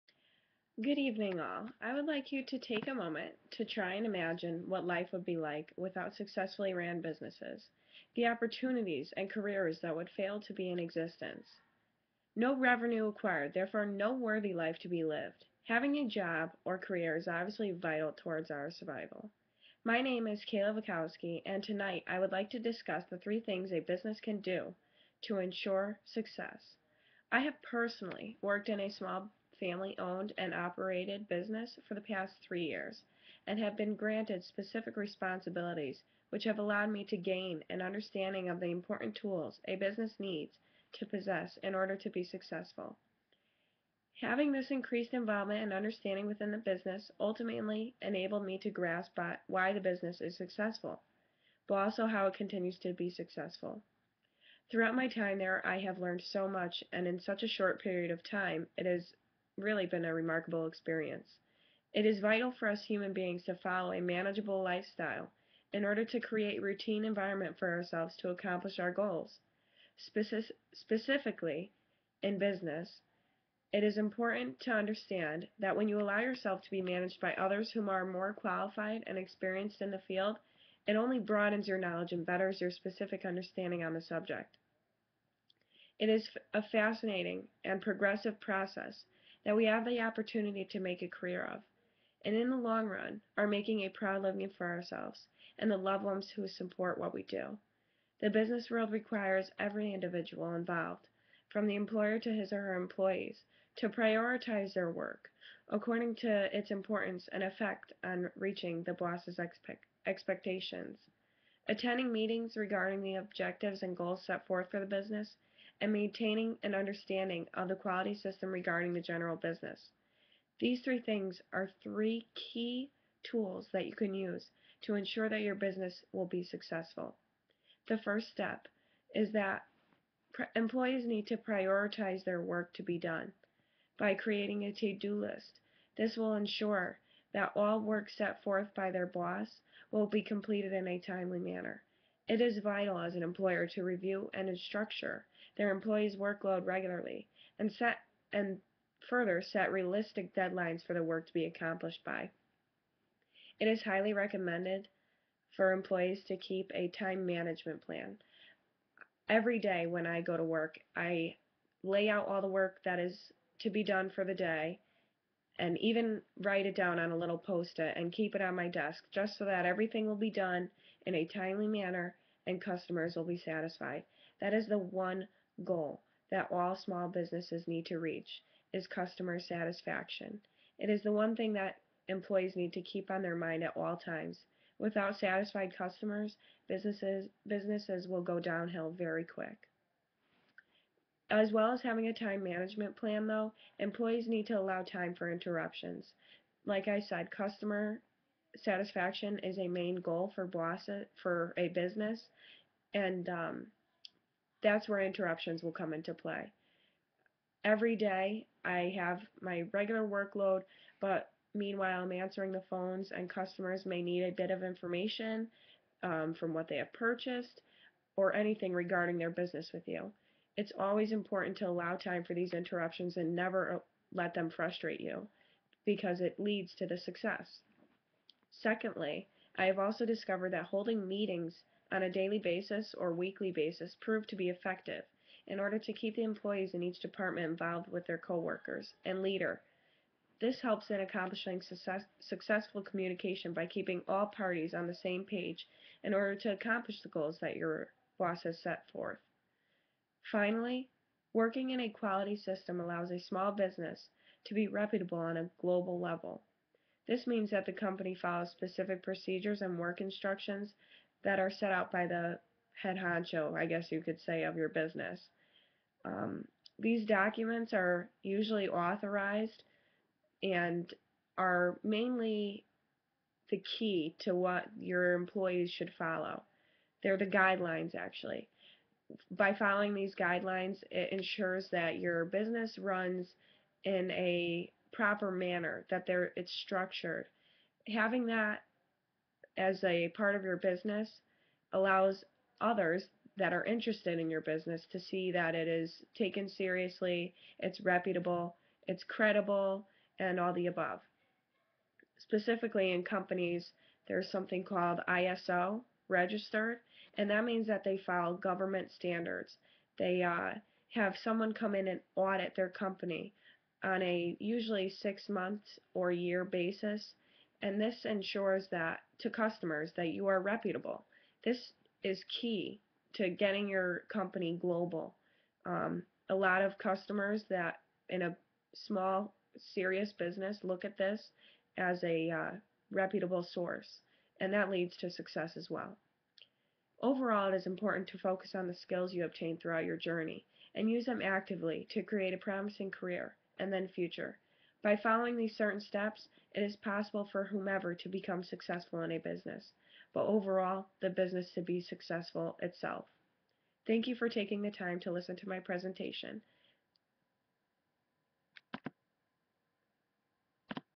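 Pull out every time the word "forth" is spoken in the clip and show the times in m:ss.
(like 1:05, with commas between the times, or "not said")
1:54, 2:18, 4:08.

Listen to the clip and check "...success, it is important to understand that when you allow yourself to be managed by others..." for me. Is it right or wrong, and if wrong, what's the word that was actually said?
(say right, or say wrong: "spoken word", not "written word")
wrong: "business", not "success".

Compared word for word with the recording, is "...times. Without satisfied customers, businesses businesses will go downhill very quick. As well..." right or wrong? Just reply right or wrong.
right.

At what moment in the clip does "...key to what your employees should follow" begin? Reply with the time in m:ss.
4:33.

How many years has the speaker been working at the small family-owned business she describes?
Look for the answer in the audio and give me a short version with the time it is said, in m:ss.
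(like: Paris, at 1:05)
3 years, at 0:32.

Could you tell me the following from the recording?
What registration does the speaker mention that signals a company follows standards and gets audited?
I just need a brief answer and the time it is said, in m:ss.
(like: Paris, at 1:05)
ISO registered, at 5:05.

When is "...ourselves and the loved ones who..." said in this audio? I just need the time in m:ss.
1:34.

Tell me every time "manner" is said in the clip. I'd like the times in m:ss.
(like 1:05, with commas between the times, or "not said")
2:21, 2:51, 4:45.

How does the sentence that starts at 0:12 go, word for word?
No revenue acquired, therefore no worthy life to be lived.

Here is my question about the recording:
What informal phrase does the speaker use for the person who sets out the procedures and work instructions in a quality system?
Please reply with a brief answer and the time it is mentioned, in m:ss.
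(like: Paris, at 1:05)
head honcho, at 4:22.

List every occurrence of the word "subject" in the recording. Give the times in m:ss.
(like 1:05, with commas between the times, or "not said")
1:24.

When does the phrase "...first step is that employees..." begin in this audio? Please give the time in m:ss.
2:08.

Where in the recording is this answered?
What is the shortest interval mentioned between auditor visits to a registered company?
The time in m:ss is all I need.
5:15.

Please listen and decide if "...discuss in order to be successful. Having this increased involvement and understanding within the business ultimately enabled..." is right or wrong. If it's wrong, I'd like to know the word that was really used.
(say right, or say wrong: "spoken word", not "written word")
wrong: "possess", not "discuss".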